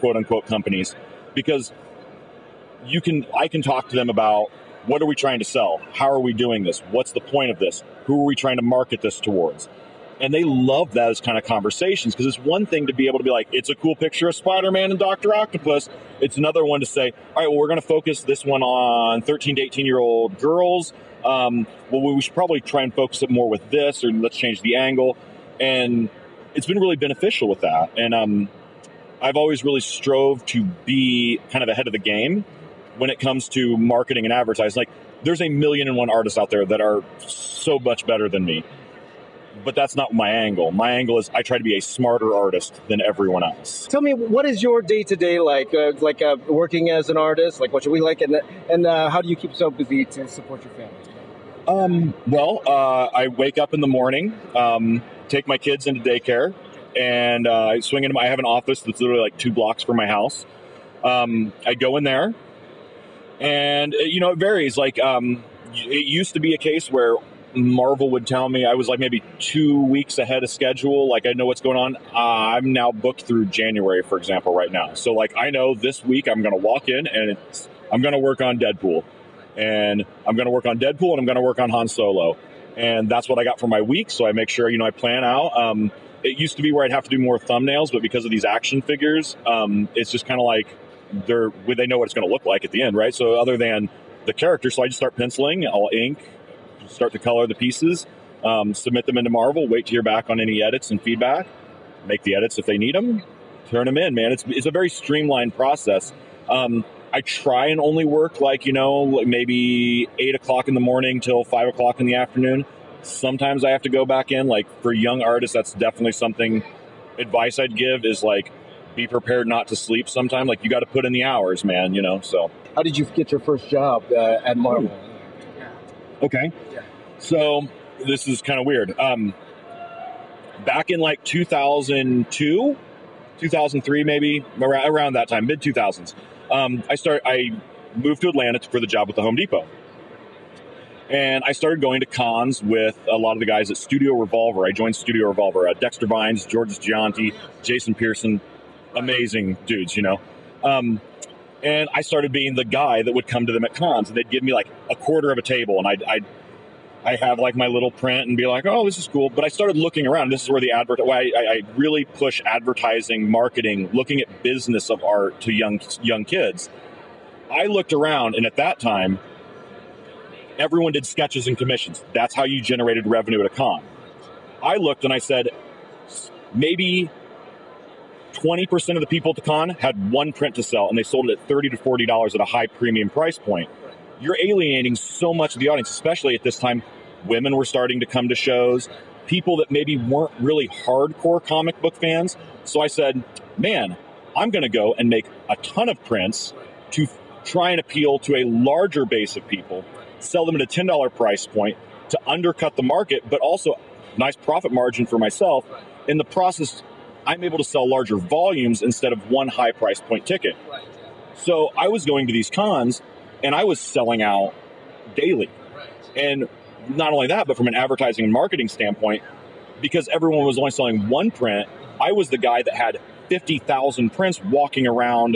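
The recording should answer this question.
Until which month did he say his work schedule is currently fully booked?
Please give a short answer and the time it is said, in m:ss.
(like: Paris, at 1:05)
January, at 1:13.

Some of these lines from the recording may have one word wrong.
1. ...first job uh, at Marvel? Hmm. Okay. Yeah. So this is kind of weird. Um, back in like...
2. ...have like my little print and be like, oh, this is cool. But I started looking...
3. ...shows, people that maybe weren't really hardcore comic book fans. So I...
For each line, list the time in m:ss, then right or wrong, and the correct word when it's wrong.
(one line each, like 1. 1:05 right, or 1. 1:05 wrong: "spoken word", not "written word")
1. 2:03 right
2. 2:37 right
3. 3:08 right.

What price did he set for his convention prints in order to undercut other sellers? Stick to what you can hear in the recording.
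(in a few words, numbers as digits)
$10.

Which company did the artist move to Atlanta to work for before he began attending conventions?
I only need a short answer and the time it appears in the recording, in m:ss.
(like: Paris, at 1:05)
The Home Depot, at 2:19.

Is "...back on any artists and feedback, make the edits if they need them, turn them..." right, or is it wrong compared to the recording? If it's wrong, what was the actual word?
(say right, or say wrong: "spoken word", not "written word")
wrong: "edits", not "artists".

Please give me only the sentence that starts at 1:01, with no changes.
Um, I go in there, and uh, you know it varies.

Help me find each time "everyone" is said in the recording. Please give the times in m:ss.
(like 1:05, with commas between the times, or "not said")
0:43, 2:50, 3:40.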